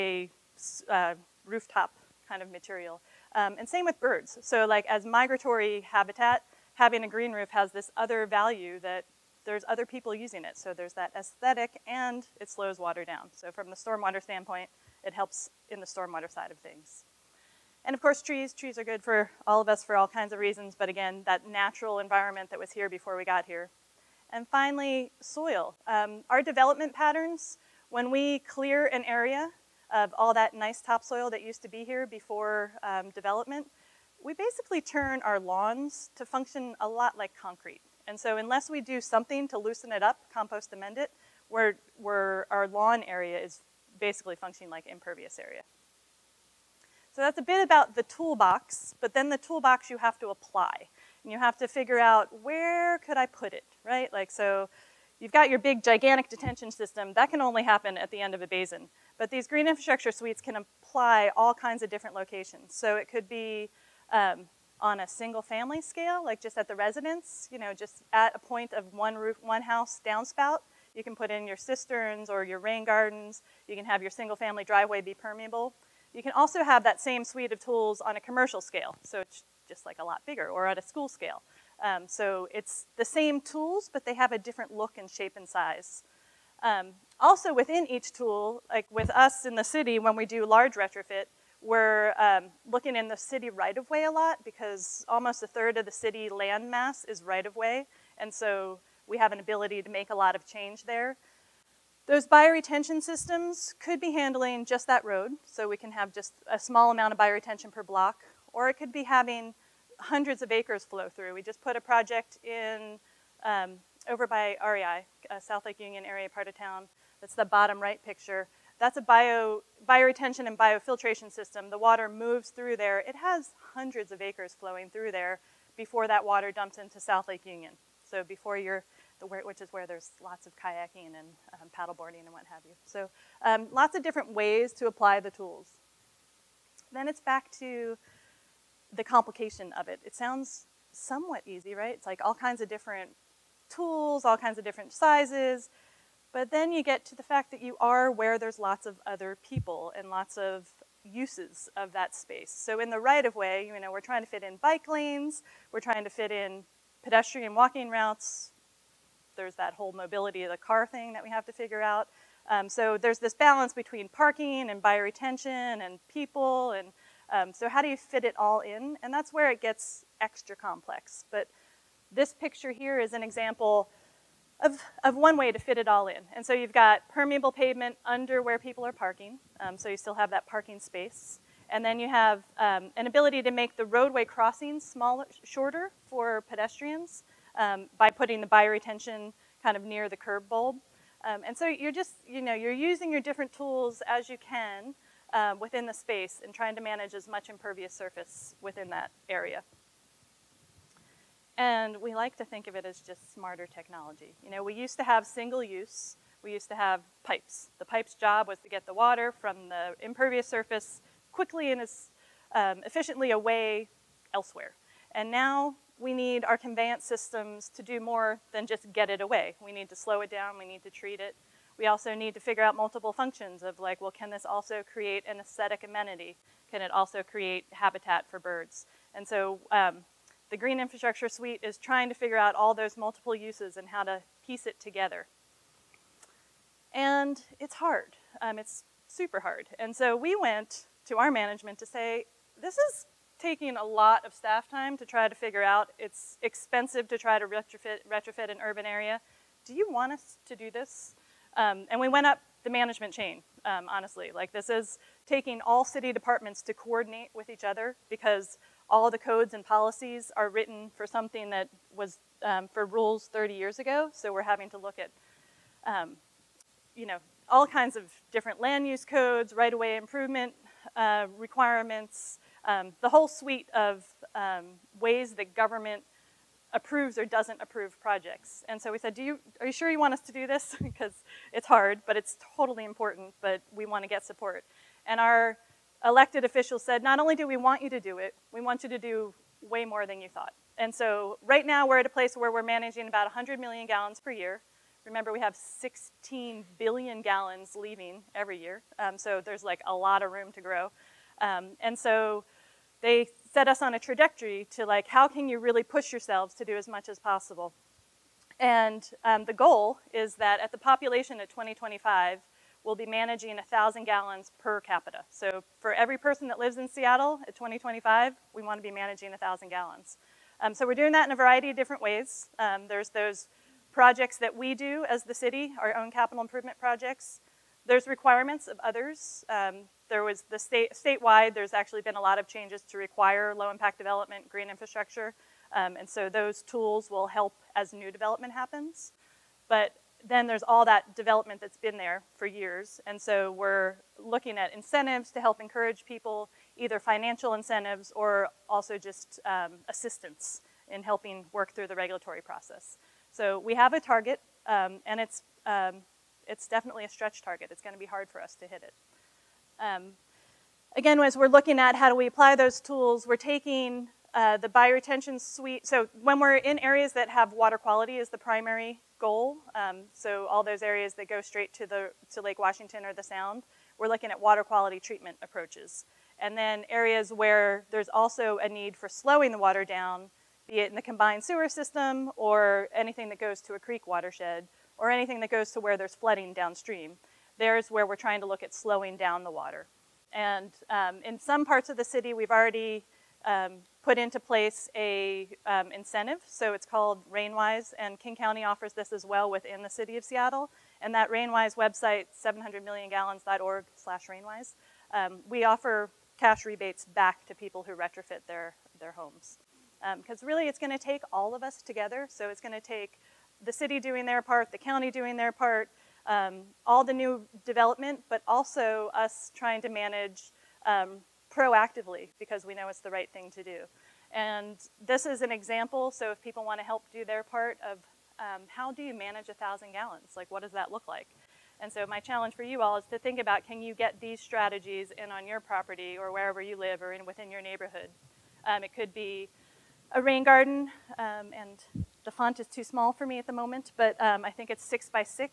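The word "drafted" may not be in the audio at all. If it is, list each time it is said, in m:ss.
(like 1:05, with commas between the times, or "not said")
not said.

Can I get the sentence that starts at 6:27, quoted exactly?
There's where we're trying to look at slowing down the water.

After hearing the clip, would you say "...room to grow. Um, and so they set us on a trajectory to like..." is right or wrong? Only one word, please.
right.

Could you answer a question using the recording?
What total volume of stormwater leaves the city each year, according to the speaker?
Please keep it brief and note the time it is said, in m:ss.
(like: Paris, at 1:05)
16 billion gallons, at 4:55.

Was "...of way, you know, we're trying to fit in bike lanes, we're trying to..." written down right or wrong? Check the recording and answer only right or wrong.
right.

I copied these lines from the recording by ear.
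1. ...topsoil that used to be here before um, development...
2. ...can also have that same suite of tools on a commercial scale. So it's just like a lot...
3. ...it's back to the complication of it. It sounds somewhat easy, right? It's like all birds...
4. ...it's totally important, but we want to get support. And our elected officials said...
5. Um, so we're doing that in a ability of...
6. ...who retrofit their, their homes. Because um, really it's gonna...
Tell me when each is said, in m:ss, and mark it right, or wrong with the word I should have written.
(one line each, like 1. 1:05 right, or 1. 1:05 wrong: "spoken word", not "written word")
1. 0:30 right
2. 1:16 right
3. 2:17 wrong: "kinds", not "birds"
4. 4:42 right
5. 5:20 wrong: "variety", not "ability"
6. 6:47 right.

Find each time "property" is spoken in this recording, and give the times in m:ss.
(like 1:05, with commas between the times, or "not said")
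7:15.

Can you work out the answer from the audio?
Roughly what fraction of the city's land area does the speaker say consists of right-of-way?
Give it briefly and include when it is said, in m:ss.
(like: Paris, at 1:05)
a third, at 1:35.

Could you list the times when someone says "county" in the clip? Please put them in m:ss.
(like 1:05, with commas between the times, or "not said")
6:38, 6:54.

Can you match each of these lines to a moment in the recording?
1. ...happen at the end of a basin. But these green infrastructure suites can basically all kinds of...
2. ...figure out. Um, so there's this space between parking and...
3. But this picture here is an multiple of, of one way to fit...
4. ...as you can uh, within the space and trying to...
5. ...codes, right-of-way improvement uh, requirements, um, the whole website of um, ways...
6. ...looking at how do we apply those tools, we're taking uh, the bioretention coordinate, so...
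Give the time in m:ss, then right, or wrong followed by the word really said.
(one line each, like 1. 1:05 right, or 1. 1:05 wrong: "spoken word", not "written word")
1. 0:57 wrong: "apply", not "basically"
2. 2:41 wrong: "balance", not "space"
3. 2:51 wrong: "example", not "multiple"
4. 3:14 right
5. 4:29 wrong: "suite", not "website"
6. 6:01 wrong: "suite", not "coordinate".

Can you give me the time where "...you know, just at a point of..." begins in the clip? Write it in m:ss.
1:07.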